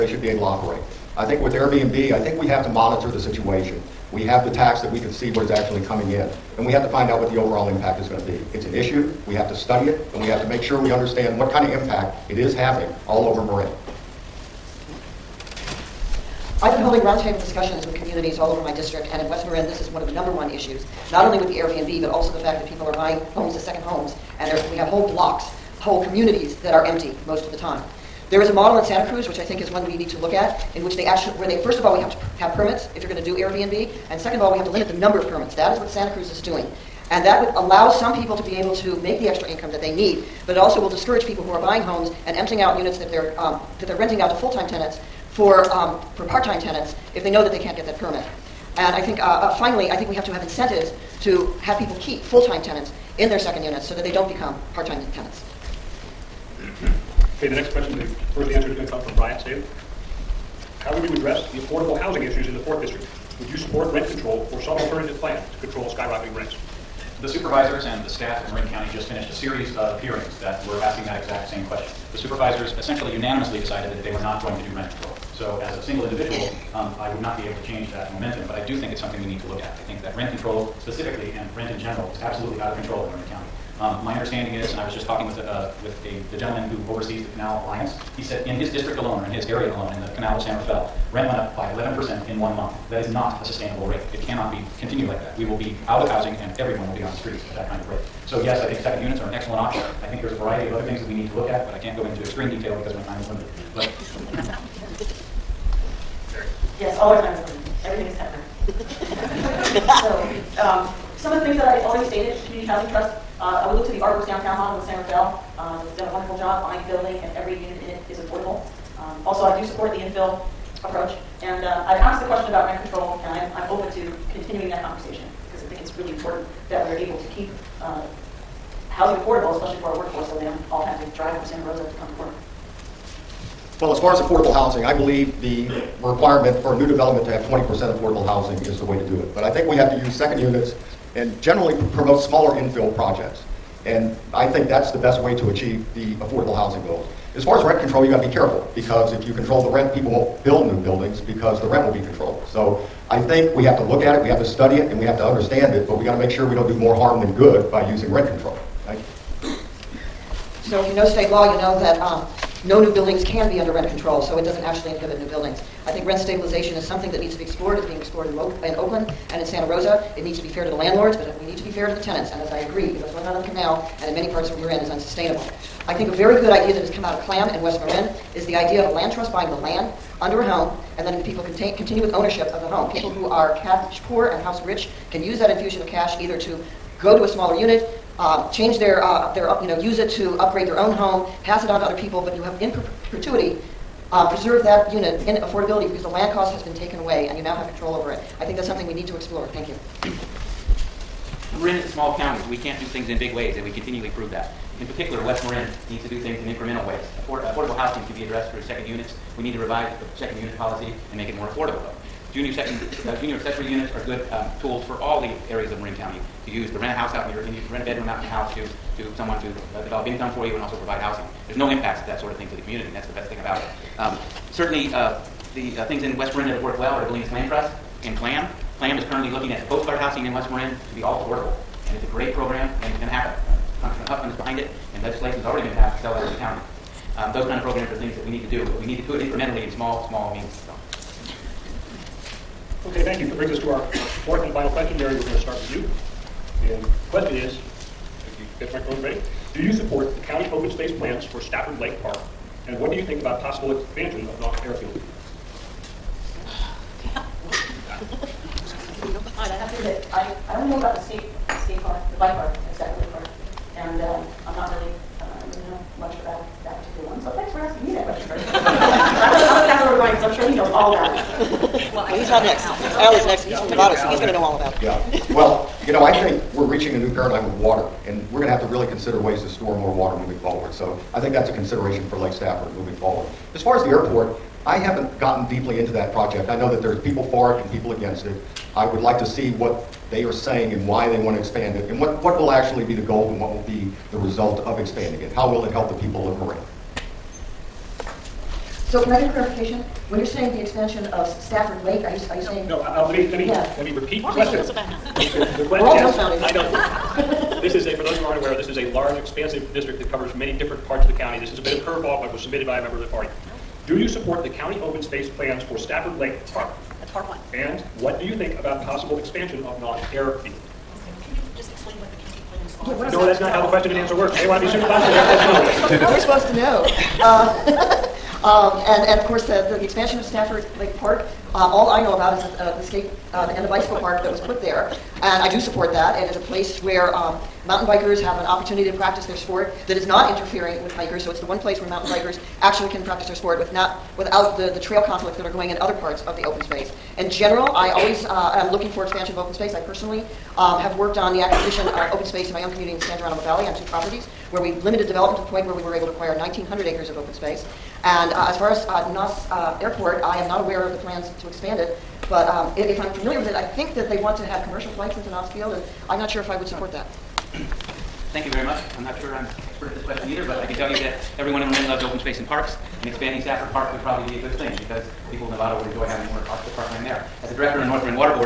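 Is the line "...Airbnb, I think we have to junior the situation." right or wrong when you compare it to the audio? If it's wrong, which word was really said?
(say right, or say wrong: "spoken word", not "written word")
wrong: "monitor", not "junior".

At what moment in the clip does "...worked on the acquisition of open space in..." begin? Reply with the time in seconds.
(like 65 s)
350 s.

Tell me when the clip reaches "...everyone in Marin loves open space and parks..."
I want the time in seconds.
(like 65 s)
371 s.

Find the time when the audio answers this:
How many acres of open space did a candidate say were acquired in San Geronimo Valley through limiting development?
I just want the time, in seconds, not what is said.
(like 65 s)
356 s.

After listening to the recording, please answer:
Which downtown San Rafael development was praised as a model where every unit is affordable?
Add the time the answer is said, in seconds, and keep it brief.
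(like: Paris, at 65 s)
Artworks Downtown, at 113 s.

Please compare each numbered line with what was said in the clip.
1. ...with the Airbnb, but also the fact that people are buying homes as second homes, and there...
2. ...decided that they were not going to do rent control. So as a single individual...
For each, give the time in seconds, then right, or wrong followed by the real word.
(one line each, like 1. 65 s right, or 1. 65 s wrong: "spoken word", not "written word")
1. 21 s right
2. 73 s right.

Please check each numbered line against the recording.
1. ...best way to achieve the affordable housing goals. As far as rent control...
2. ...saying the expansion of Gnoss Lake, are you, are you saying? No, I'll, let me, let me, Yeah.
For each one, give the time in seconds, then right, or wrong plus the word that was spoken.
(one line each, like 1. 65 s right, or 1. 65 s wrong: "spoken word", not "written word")
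1. 144 s right
2. 300 s wrong: "Stafford", not "Gnoss".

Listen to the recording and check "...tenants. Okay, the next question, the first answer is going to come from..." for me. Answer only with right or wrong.
right.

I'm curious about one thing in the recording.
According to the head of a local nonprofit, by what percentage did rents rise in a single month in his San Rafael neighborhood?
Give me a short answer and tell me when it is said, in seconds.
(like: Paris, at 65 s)
11%, at 91 s.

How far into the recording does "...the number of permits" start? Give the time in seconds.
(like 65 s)
34 s.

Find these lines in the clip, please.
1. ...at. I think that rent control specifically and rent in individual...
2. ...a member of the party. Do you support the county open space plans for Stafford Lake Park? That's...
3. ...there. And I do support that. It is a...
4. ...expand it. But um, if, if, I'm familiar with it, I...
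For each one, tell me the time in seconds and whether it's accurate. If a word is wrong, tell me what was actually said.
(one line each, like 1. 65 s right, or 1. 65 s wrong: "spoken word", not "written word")
1. 79 s wrong: "general", not "individual"
2. 312 s right
3. 334 s right
4. 361 s right.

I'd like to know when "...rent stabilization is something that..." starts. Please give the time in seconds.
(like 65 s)
166 s.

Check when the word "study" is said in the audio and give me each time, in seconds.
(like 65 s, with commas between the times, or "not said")
9 s, 154 s.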